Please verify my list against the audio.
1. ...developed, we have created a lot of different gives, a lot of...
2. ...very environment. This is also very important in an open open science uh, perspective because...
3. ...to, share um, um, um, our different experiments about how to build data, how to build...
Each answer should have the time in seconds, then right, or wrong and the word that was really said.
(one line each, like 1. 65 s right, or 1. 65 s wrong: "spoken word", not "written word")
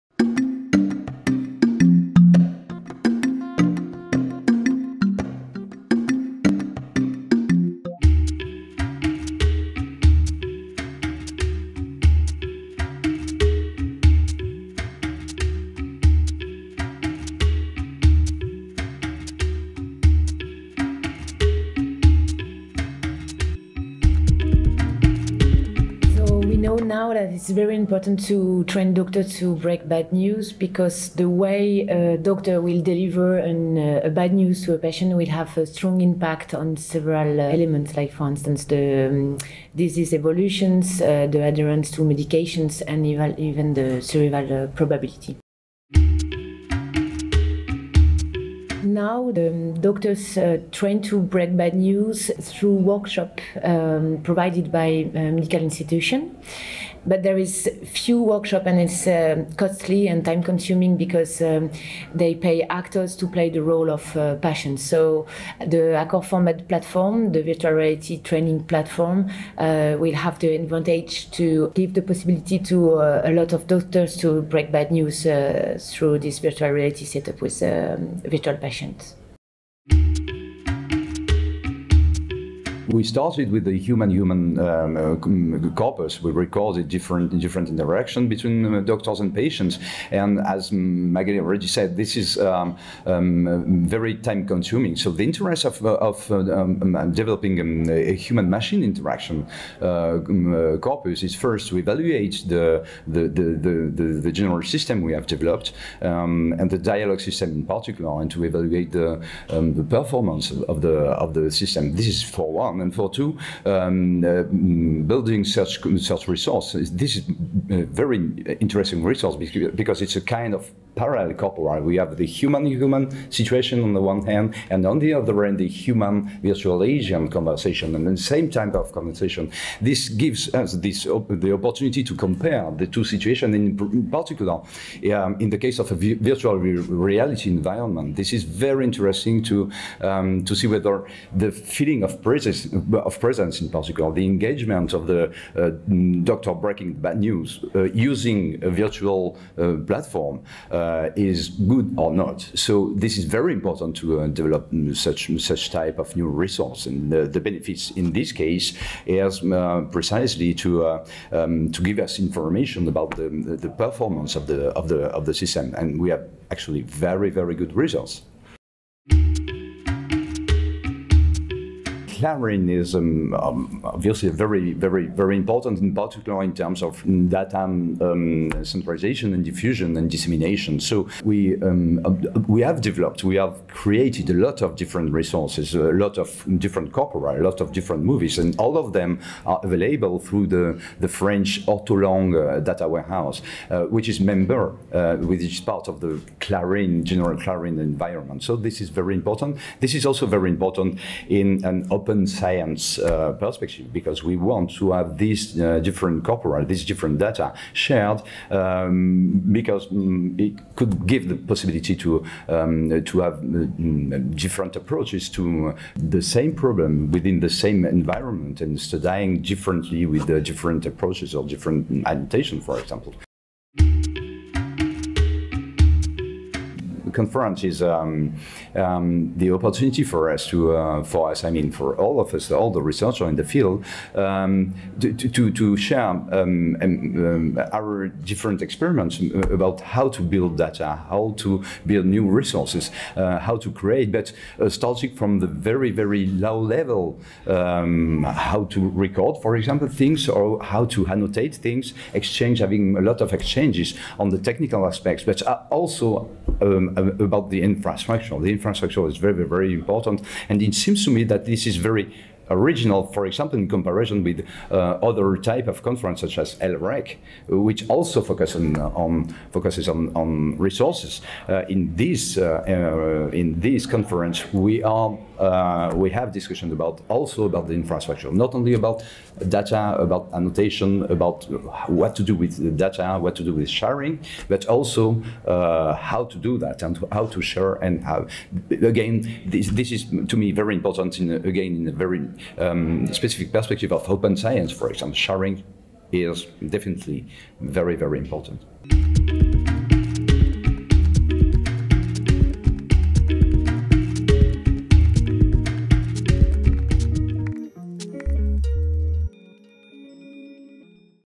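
1. 182 s wrong: "resources", not "gives"
2. 198 s wrong: "important", not "environment"
3. 235 s right.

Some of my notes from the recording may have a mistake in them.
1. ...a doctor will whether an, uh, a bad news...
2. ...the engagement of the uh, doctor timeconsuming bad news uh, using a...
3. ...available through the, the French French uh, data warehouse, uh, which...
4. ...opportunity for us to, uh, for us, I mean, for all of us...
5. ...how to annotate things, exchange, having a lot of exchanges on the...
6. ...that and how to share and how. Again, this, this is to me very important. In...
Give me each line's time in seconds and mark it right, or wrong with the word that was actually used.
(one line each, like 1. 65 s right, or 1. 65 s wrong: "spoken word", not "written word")
1. 31 s wrong: "deliver", not "whether"
2. 144 s wrong: "breaking", not "timeconsuming"
3. 189 s wrong: "Ortolang", not "French"
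4. 229 s right
5. 250 s right
6. 286 s right.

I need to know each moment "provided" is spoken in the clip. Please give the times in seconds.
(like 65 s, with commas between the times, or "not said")
54 s.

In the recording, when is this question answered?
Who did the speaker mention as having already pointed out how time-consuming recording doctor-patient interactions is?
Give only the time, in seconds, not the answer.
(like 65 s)
90 s.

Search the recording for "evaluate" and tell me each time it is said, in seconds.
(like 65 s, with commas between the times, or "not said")
101 s, 108 s.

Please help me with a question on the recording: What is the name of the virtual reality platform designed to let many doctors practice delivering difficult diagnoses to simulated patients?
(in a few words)
ACORFORMed.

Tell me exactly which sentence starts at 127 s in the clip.
And the same type of conversation, this gives us this the opportunity to compare the two situations.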